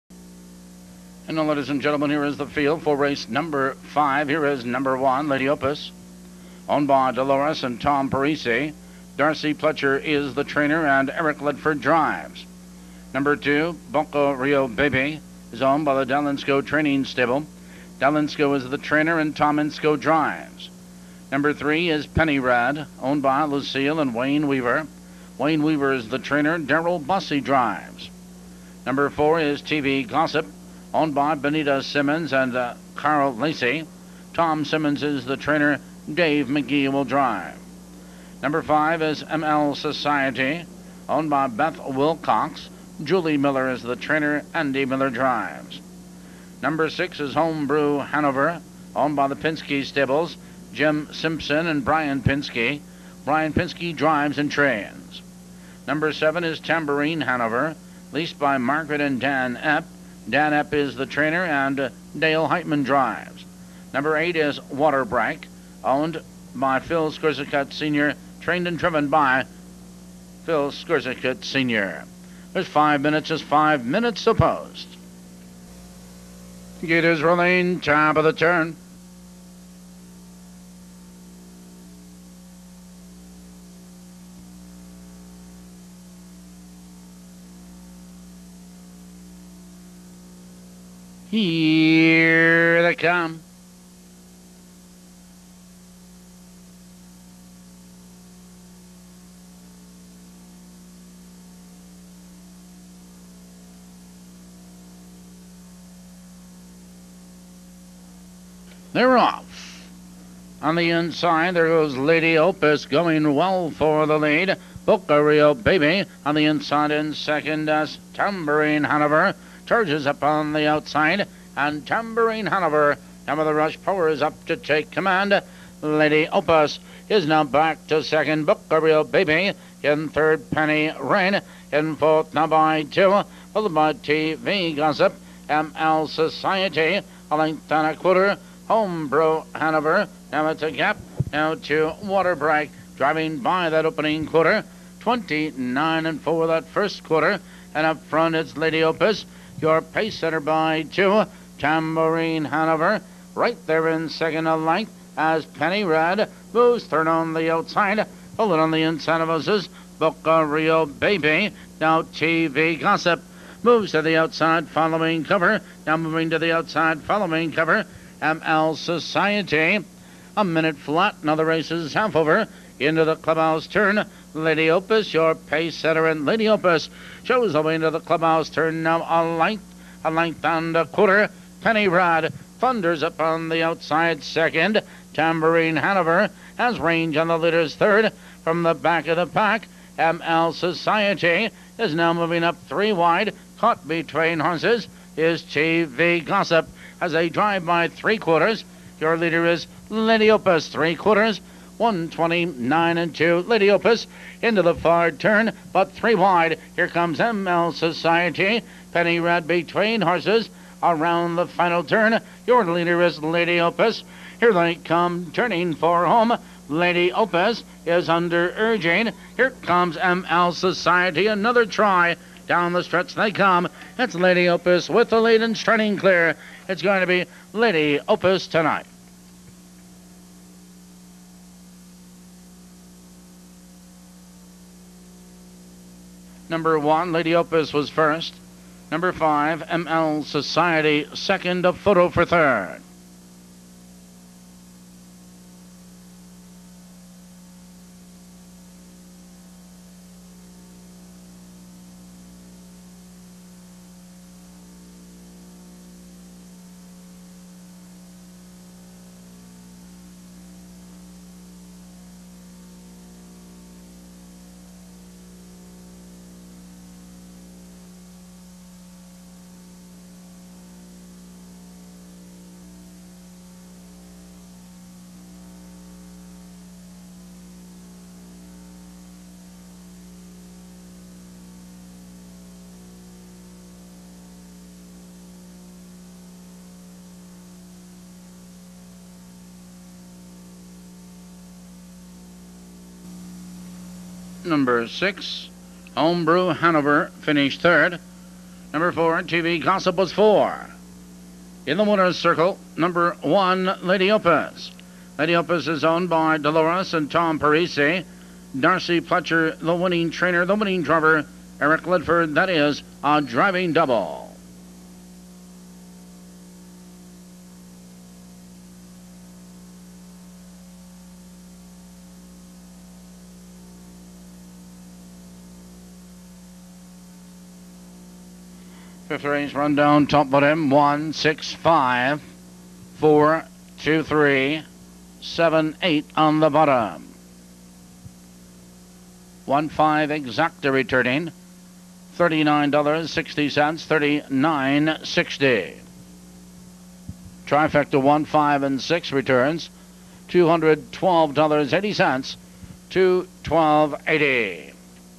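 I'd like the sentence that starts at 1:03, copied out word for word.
Number eight is Waterbrake, owned by Phil Skurzicut Sr., trained and driven by Phil Skurzicut Sr.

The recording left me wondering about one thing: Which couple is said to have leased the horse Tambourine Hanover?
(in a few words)
Margaret and Dan Epp.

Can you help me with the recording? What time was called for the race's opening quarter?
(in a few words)
29 and 4.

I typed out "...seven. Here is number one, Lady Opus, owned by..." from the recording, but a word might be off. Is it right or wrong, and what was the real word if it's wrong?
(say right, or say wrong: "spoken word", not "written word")
wrong: "five", not "seven".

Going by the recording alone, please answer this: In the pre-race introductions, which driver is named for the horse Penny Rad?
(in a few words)
Daryl Busse.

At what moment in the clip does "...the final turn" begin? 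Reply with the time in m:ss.
3:31.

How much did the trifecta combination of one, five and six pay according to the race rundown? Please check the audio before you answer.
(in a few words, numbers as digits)
$212.80.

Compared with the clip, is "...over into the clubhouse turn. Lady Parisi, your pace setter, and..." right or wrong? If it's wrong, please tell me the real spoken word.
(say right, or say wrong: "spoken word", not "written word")
wrong: "Opus", not "Parisi".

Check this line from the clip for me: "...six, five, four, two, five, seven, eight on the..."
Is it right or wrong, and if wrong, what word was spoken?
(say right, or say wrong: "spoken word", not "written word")
wrong: "three", not "five".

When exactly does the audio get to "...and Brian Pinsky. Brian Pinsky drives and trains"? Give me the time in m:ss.
0:51.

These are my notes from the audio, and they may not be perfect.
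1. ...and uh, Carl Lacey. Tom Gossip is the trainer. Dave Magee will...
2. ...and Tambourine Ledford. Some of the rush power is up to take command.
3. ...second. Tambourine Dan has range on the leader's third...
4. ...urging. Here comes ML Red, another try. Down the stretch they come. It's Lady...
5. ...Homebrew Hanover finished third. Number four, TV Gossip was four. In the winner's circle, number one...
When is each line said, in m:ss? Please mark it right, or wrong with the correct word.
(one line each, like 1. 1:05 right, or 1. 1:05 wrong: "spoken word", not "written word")
1. 0:32 wrong: "Simmons", not "Gossip"
2. 2:01 wrong: "Hanover", not "Ledford"
3. 3:04 wrong: "Hanover", not "Dan"
4. 3:38 wrong: "Society", not "Red"
5. 4:55 right.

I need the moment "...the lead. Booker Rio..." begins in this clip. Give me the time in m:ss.
1:54.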